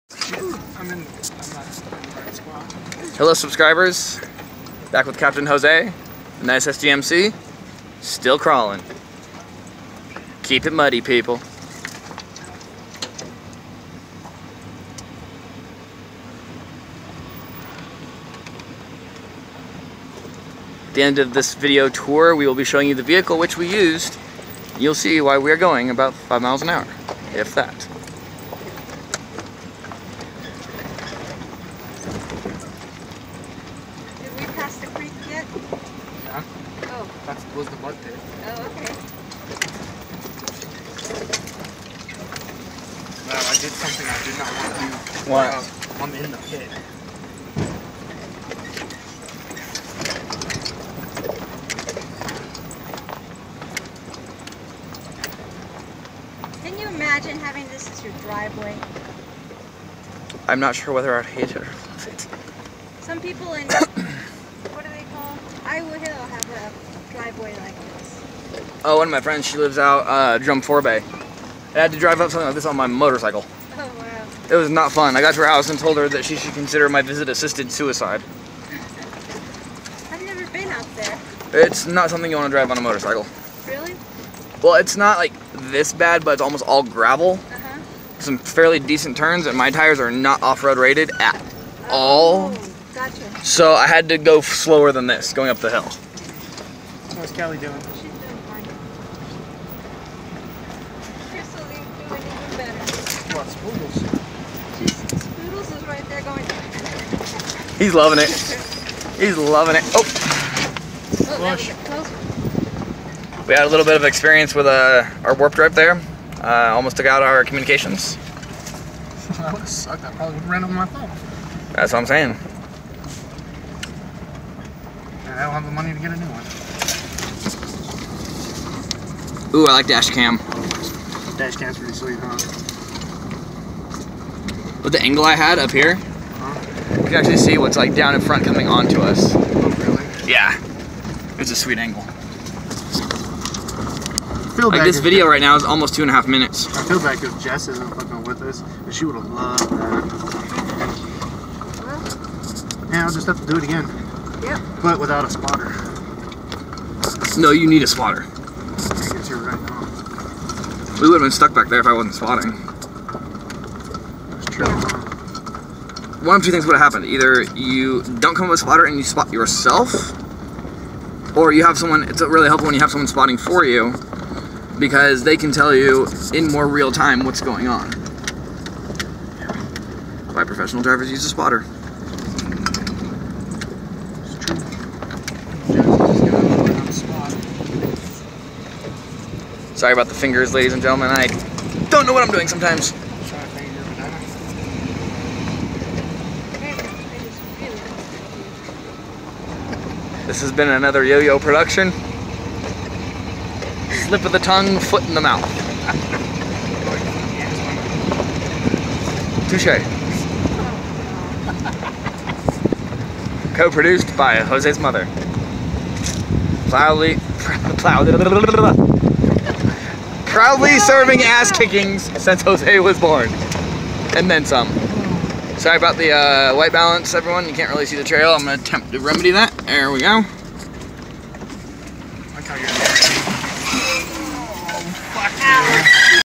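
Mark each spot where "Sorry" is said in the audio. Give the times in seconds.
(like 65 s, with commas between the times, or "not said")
189 s, 225 s.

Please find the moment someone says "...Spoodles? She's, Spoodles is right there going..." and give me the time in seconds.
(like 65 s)
103 s.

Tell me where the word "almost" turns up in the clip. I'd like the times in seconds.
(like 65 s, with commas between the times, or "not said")
86 s, 116 s, 145 s.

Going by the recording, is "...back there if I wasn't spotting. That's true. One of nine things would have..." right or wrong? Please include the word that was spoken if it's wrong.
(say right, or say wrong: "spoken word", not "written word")
wrong: "two", not "nine".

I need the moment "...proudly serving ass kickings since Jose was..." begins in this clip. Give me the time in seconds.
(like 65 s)
220 s.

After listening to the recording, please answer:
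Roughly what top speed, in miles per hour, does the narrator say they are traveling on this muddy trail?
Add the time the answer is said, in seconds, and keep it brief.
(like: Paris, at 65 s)
5 miles an hour, at 26 s.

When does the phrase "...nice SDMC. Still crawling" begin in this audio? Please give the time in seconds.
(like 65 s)
6 s.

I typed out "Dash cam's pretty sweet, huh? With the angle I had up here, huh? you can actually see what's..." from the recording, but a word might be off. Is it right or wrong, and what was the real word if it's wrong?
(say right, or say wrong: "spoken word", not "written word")
right.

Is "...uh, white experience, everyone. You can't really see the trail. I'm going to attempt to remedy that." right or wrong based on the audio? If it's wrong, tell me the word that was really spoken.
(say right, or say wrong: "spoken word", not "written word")
wrong: "balance", not "experience".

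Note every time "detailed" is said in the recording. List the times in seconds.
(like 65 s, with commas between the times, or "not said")
not said.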